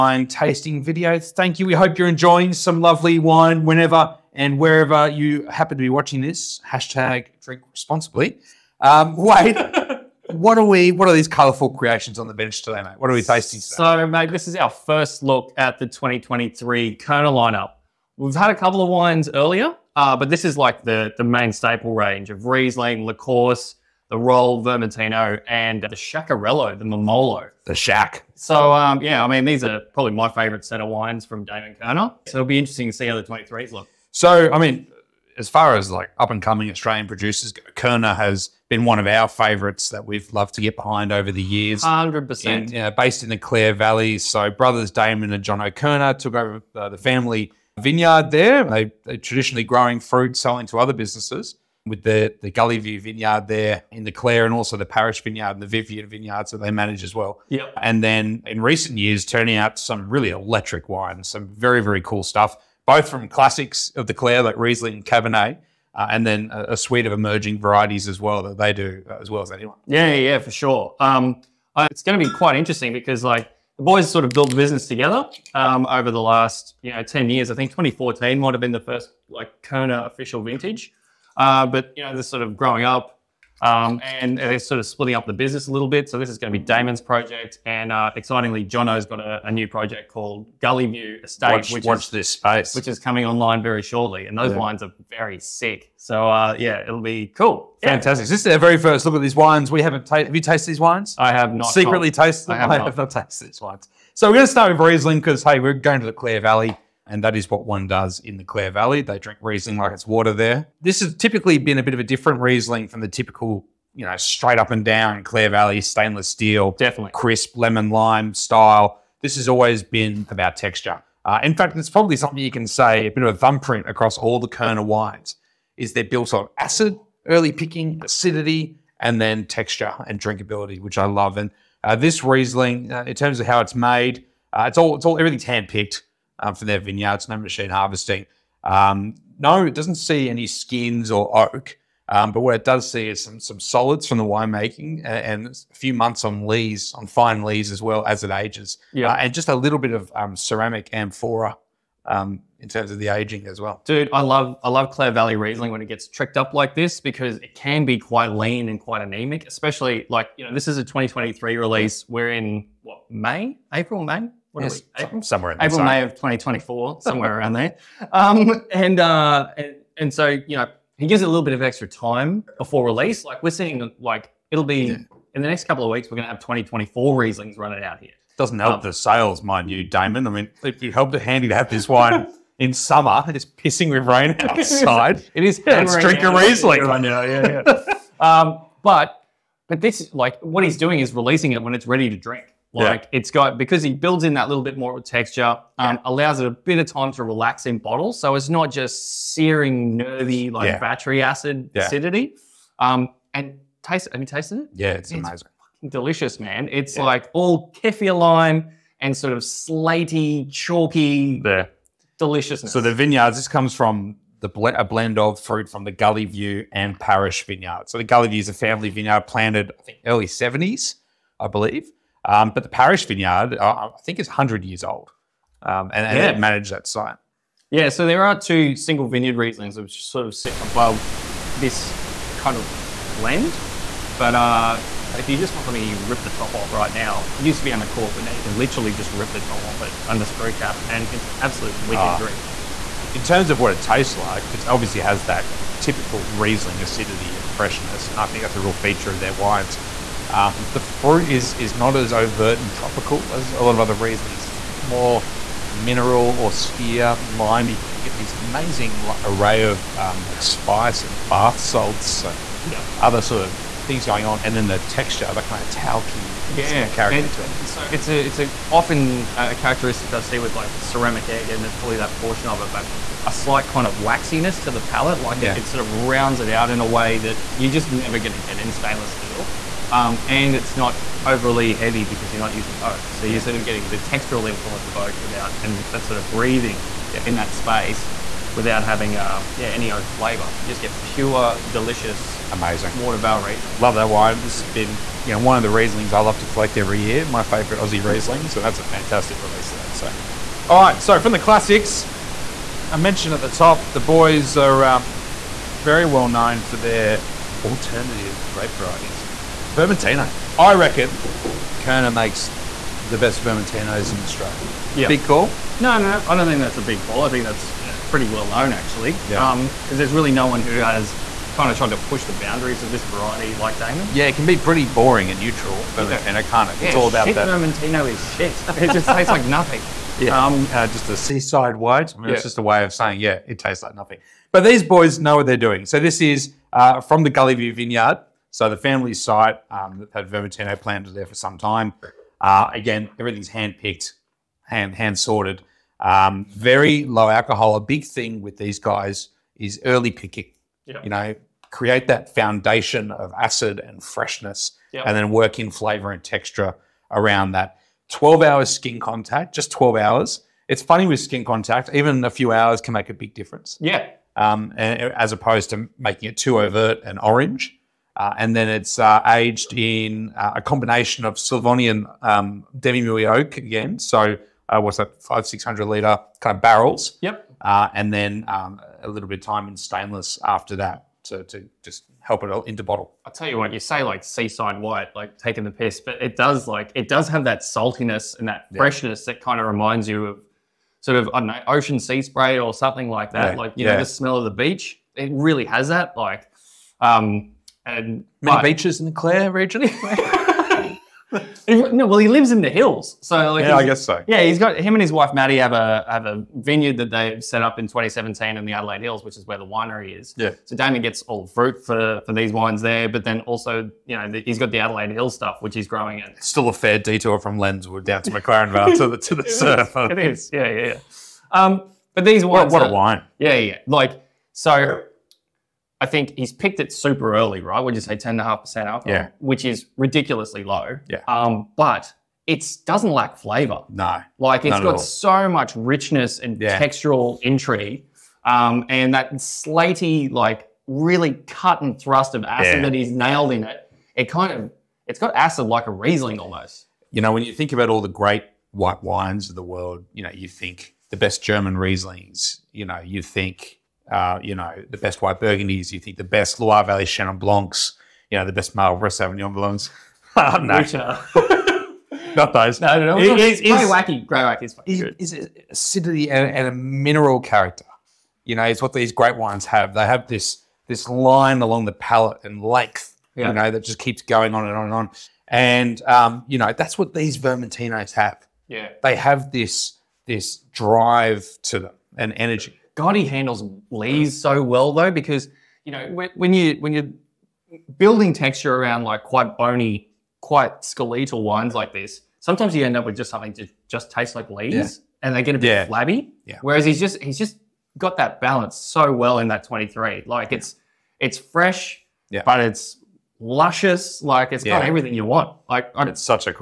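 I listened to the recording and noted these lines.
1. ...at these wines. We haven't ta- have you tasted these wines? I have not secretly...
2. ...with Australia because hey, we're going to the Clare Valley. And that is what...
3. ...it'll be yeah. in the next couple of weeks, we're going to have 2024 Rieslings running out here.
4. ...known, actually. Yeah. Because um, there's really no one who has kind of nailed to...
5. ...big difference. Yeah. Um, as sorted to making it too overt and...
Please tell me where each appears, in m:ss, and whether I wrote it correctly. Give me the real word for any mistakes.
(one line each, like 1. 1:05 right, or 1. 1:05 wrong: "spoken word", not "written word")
1. 1:39 right
2. 1:44 wrong: "Riesling", not "Australia"
3. 2:54 right
4. 5:18 wrong: "tried", not "nailed"
5. 6:03 wrong: "opposed", not "sorted".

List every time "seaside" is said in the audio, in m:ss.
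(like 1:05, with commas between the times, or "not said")
5:31, 6:24.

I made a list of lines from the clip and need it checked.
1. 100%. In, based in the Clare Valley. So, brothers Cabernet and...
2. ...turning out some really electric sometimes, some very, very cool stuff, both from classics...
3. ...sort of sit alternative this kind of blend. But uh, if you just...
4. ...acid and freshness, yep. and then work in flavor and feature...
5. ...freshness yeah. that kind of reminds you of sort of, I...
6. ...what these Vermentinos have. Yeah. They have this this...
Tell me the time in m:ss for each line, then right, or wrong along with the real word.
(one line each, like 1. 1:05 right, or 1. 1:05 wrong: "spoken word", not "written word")
1. 0:41 wrong: "Damon", not "Cabernet"
2. 0:59 wrong: "wines", not "sometimes"
3. 3:50 wrong: "above", not "alternative"
4. 5:53 wrong: "texture", not "feature"
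5. 6:28 right
6. 7:56 right.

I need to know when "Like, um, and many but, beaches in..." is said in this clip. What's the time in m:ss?
6:36.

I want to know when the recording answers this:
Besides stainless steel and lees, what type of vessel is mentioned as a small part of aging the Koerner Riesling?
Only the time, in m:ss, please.
2:30.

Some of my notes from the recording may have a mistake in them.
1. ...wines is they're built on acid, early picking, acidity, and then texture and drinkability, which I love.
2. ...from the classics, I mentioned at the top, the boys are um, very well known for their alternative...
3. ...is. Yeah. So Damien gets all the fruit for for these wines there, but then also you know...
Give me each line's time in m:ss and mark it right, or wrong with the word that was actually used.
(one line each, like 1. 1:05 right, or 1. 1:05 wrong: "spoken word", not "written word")
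1. 2:04 right
2. 5:01 right
3. 6:50 right.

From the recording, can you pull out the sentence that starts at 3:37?
So the Gully View is a family vineyard planted, I think, early seventies, I believe.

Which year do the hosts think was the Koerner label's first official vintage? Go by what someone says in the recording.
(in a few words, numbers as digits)
2014.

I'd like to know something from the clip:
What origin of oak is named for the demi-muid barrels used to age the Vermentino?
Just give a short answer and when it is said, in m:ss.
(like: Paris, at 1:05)
Slavonian, at 6:11.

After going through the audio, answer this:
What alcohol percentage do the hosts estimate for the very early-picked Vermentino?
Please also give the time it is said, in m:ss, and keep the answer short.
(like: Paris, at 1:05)
10.5%, at 7:08.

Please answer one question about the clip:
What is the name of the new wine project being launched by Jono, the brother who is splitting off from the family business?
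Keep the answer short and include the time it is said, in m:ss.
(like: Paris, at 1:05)
Gully View Estate, at 1:30.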